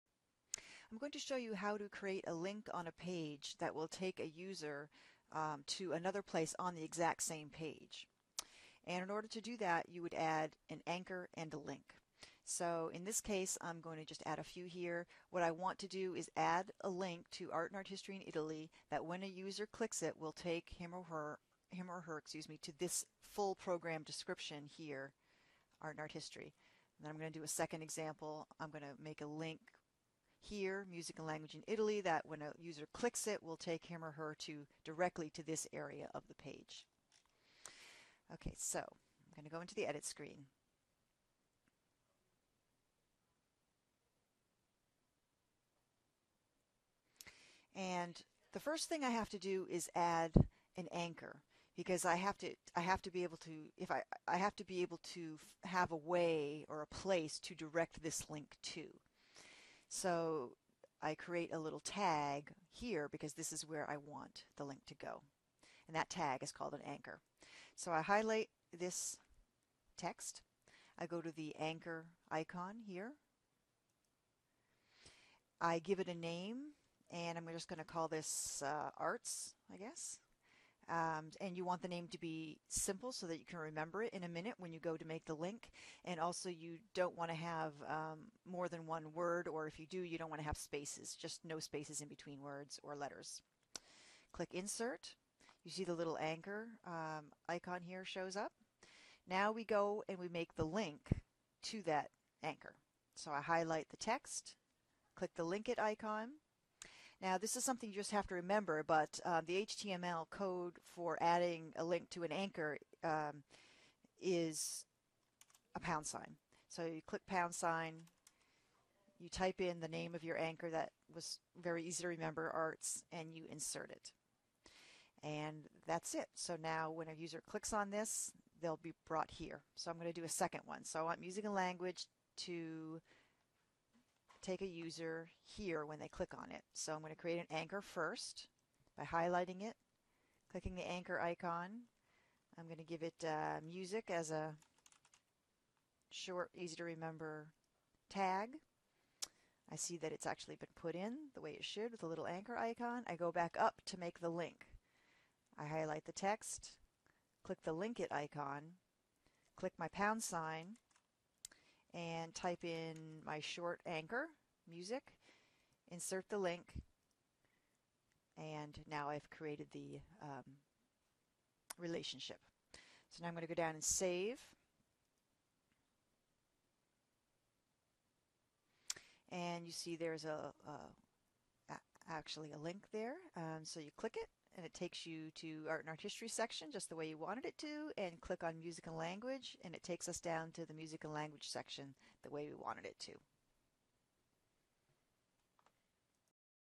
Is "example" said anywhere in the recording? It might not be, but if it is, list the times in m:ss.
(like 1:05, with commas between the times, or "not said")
0:27.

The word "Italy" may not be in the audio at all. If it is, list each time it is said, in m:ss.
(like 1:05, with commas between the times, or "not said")
0:18, 0:31.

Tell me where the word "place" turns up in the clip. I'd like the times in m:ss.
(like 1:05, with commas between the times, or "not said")
0:06, 0:56.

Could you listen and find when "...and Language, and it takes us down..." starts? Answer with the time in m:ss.
3:08.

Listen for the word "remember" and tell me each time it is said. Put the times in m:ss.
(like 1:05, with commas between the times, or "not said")
1:23, 1:48, 2:02, 2:26.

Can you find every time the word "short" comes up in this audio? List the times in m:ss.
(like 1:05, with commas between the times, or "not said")
2:26, 2:43.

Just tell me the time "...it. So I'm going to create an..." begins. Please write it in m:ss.
2:16.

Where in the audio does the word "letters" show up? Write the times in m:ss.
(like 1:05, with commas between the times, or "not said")
1:32.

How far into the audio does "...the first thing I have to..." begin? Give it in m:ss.
0:48.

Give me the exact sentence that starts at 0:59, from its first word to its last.
So I create a little tag here because this is where I want the link to go.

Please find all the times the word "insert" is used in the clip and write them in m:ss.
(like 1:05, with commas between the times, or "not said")
1:34, 2:03, 2:45.